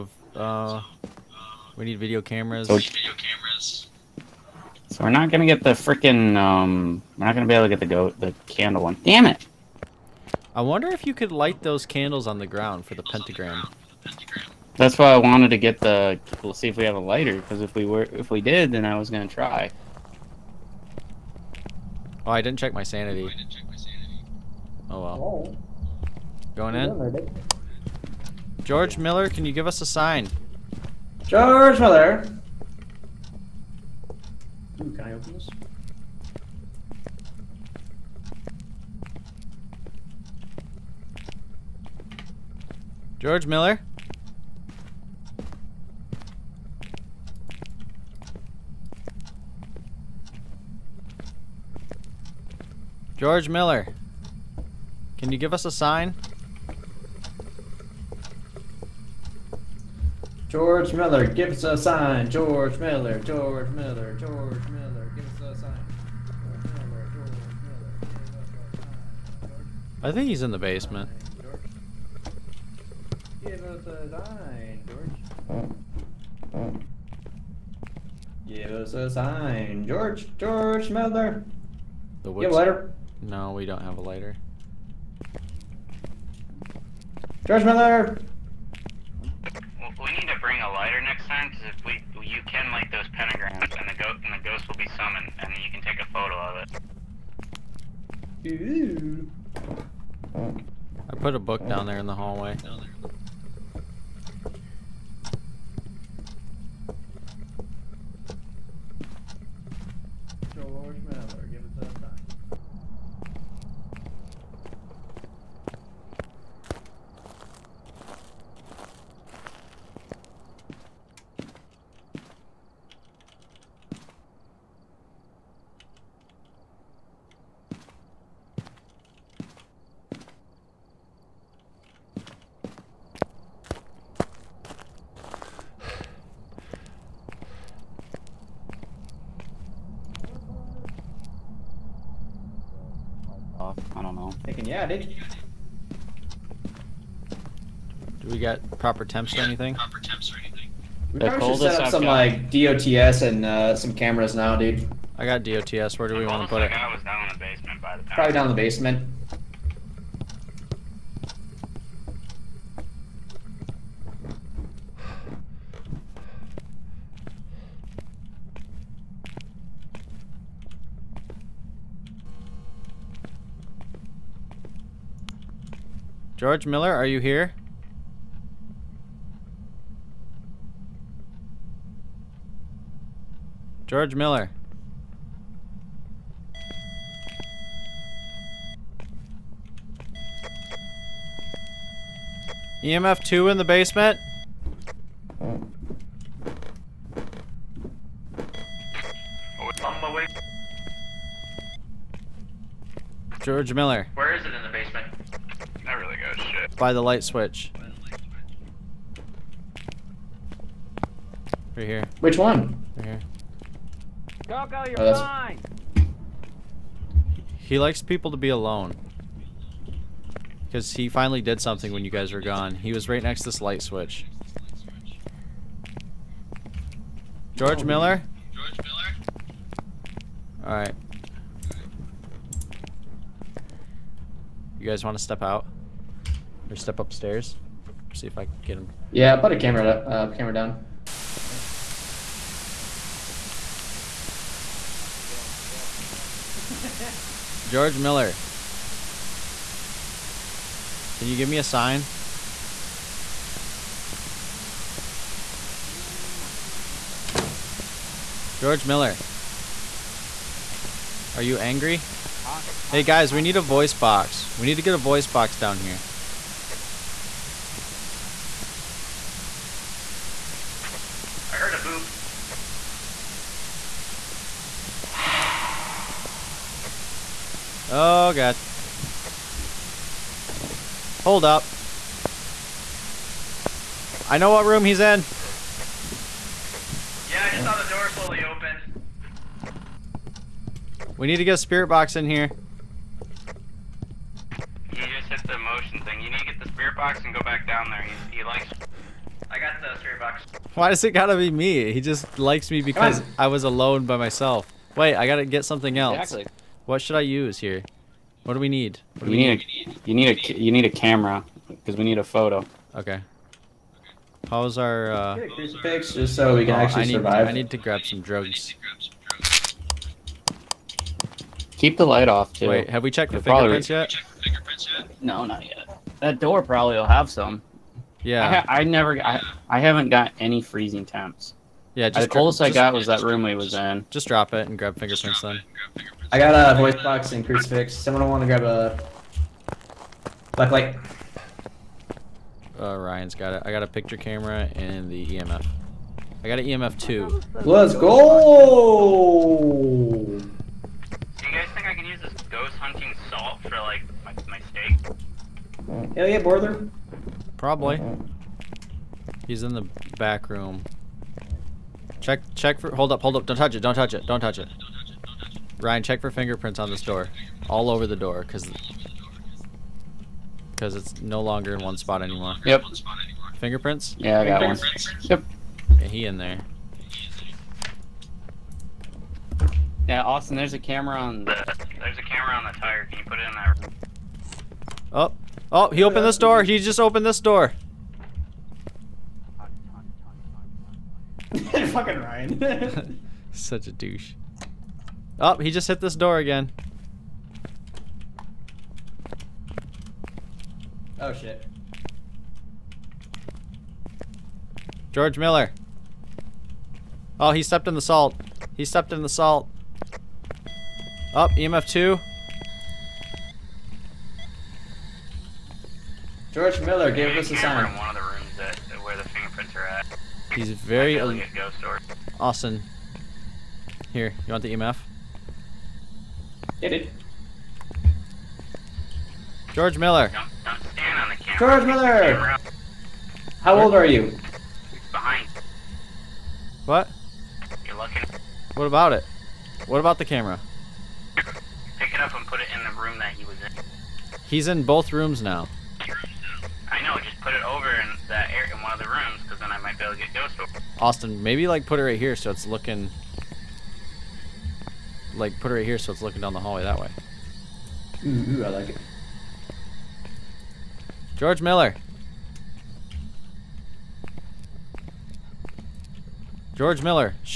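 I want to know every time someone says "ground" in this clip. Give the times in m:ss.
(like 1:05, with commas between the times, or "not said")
0:12.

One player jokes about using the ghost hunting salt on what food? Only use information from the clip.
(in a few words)
Steak.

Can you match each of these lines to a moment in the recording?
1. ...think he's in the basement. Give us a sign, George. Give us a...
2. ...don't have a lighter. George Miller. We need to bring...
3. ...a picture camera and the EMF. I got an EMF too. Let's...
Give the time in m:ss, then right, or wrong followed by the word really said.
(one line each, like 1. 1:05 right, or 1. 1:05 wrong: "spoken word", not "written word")
1. 1:10 right
2. 1:23 right
3. 5:43 right.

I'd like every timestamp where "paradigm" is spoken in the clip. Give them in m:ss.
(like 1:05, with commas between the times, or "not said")
not said.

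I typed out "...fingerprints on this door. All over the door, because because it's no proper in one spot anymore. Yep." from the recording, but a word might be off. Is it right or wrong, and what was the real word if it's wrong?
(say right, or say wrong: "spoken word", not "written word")
wrong: "longer", not "proper".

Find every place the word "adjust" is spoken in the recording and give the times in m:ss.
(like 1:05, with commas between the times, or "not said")
not said.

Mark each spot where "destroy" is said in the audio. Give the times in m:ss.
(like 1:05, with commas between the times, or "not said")
not said.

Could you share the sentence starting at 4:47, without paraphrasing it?
Yeah, I just saw the door slowly open.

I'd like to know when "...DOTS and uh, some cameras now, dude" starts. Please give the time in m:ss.
2:32.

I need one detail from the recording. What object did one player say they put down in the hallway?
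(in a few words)
A book.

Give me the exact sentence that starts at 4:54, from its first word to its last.
You just hit the motion thing.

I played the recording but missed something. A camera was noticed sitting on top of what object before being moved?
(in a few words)
Tire.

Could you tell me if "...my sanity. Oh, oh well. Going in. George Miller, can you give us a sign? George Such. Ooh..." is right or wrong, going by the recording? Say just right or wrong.
wrong.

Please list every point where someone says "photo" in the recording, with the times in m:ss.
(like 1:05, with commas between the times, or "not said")
1:36, 5:12.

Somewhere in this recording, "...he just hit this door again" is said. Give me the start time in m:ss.
6:35.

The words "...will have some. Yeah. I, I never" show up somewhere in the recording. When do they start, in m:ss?
5:26.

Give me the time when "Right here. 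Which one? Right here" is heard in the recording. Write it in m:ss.
3:31.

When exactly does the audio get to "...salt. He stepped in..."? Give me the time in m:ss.
6:48.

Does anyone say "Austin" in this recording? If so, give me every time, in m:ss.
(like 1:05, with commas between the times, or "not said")
6:20, 7:02, 7:31.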